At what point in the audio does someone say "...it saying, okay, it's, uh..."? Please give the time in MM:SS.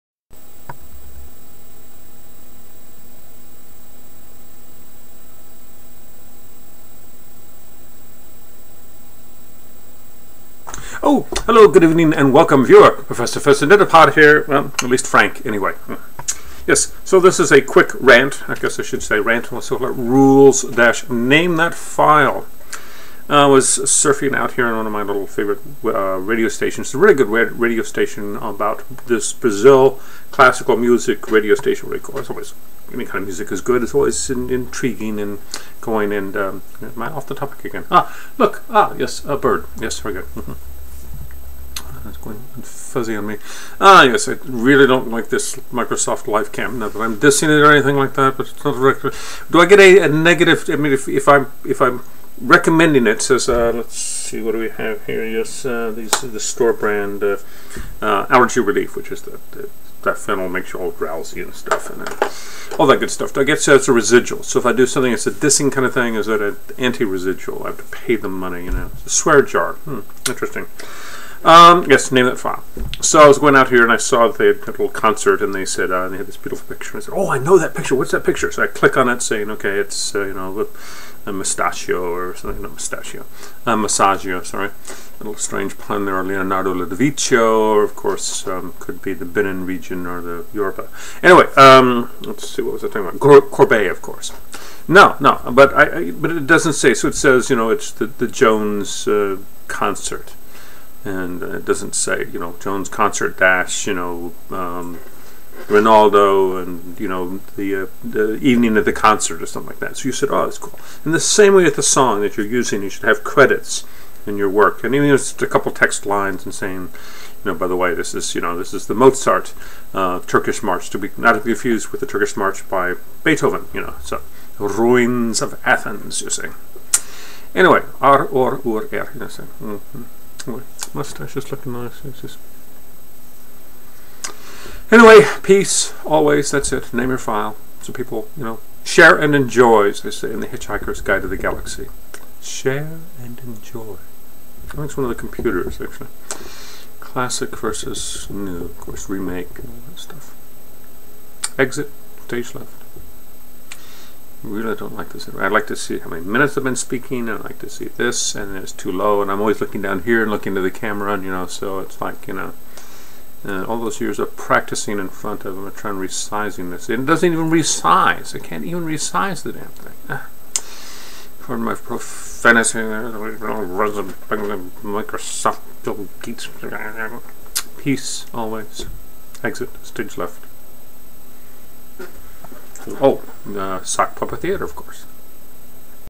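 01:19.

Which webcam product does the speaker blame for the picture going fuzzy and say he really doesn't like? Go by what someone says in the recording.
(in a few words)
Microsoft LifeCam.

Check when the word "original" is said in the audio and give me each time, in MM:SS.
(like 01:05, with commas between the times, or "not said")
not said.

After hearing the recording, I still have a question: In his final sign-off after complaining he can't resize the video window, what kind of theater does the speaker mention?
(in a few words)
sock puppet theater.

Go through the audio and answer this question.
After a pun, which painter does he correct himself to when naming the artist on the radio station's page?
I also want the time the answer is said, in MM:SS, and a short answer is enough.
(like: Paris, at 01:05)
Masaccio, at 01:23.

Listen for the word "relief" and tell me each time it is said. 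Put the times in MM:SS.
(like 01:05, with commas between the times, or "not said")
00:58.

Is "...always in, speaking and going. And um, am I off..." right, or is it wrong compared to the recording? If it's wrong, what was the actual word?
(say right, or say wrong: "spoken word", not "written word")
wrong: "intriguing", not "speaking".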